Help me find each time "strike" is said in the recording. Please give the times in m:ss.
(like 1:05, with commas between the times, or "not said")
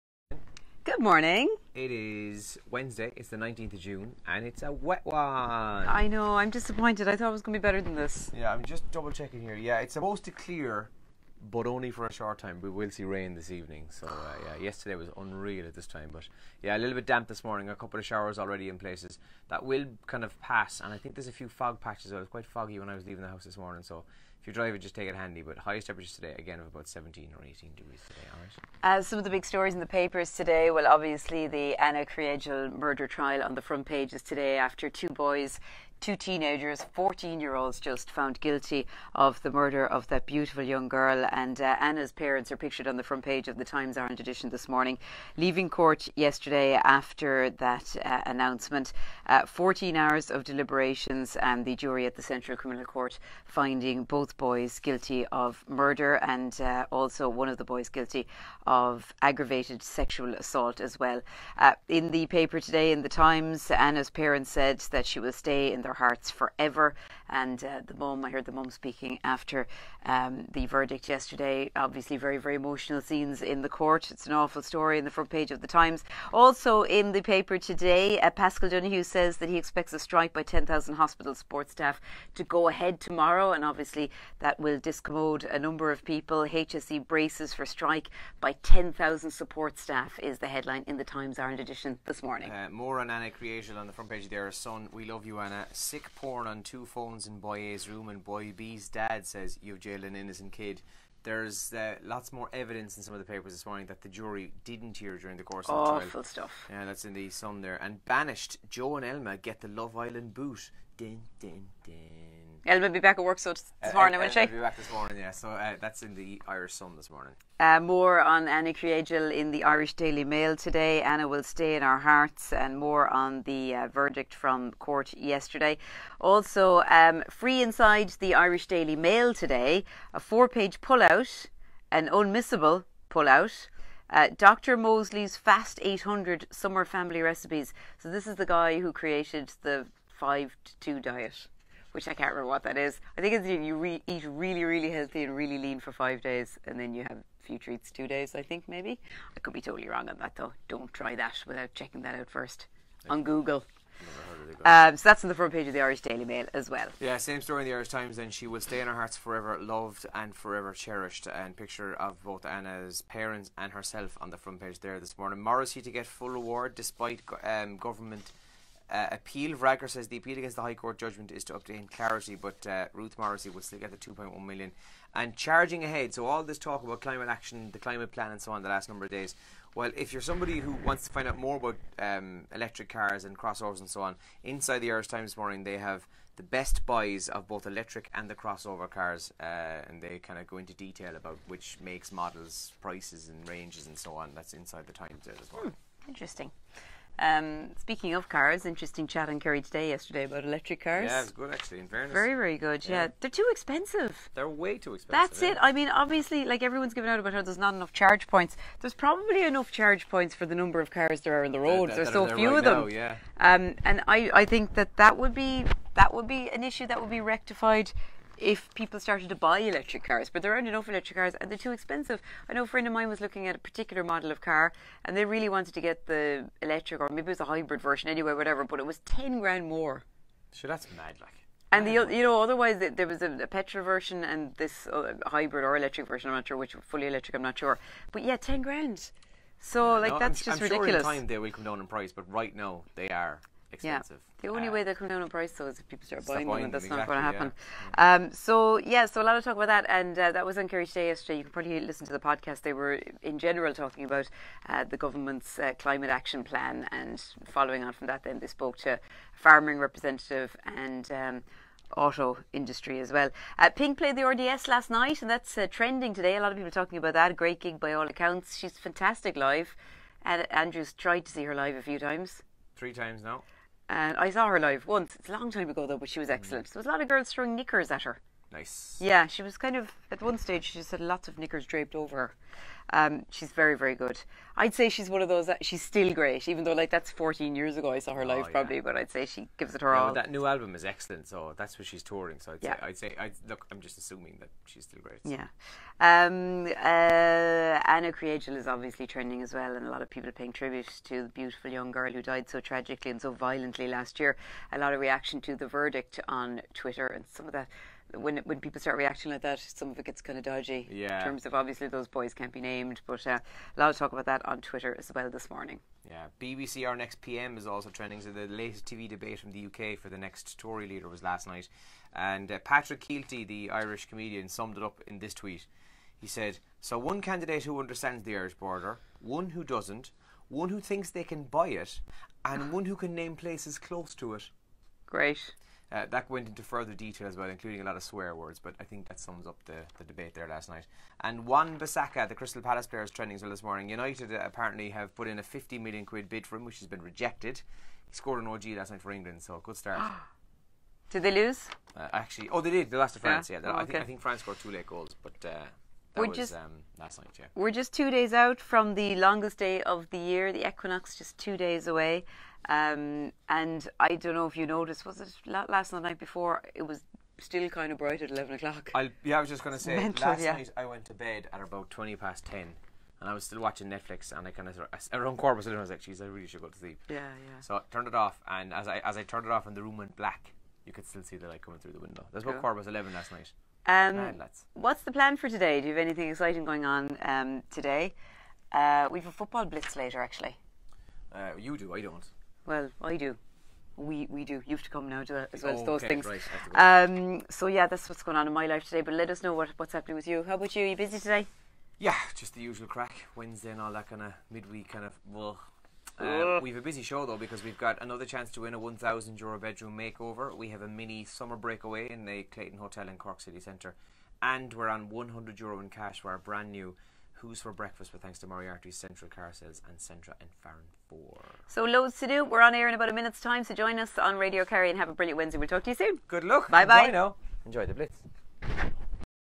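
1:19, 1:27.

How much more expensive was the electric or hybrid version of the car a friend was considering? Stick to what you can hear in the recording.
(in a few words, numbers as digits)
10 grand.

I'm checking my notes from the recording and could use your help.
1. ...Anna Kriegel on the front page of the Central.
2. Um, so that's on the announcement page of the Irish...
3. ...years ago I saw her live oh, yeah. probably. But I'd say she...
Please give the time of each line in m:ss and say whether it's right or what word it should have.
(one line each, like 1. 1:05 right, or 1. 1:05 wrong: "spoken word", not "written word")
1. 1:33 wrong: "Sun", not "Central"
2. 2:34 wrong: "front", not "announcement"
3. 4:47 right.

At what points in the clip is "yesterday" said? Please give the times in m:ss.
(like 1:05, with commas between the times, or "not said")
0:14, 0:46, 1:11, 2:05, 3:19, 4:11.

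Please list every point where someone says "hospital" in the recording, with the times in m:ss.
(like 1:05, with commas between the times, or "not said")
1:20.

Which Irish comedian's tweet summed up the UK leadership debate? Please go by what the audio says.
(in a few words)
Patrick Kielty.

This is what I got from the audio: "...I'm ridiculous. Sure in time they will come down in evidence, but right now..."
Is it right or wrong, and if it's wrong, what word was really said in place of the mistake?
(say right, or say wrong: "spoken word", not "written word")
wrong: "price", not "evidence".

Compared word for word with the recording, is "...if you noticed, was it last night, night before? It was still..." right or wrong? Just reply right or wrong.
right.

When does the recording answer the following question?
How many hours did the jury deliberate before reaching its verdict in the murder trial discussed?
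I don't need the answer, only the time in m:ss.
0:49.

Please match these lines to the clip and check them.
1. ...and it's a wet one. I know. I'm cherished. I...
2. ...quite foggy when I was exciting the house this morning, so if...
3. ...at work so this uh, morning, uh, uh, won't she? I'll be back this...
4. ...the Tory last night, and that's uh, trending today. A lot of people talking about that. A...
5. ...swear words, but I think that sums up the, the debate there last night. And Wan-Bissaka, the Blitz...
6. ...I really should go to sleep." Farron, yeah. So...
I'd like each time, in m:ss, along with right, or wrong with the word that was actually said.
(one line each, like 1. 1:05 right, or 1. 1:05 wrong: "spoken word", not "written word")
1. 0:04 wrong: "disappointed", not "cherished"
2. 0:22 wrong: "leaving", not "exciting"
3. 1:53 right
4. 4:24 wrong: "RDS", not "Tory"
5. 5:38 wrong: "Crystal", not "Blitz"
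6. 6:16 wrong: "Yeah", not "Farron".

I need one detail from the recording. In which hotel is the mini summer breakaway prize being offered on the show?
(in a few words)
Clayton Hotel.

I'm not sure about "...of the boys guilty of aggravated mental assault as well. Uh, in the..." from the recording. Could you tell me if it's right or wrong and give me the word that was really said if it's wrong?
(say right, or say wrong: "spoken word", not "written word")
wrong: "sexual", not "mental".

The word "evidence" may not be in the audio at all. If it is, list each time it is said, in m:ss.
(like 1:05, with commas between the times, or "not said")
1:42.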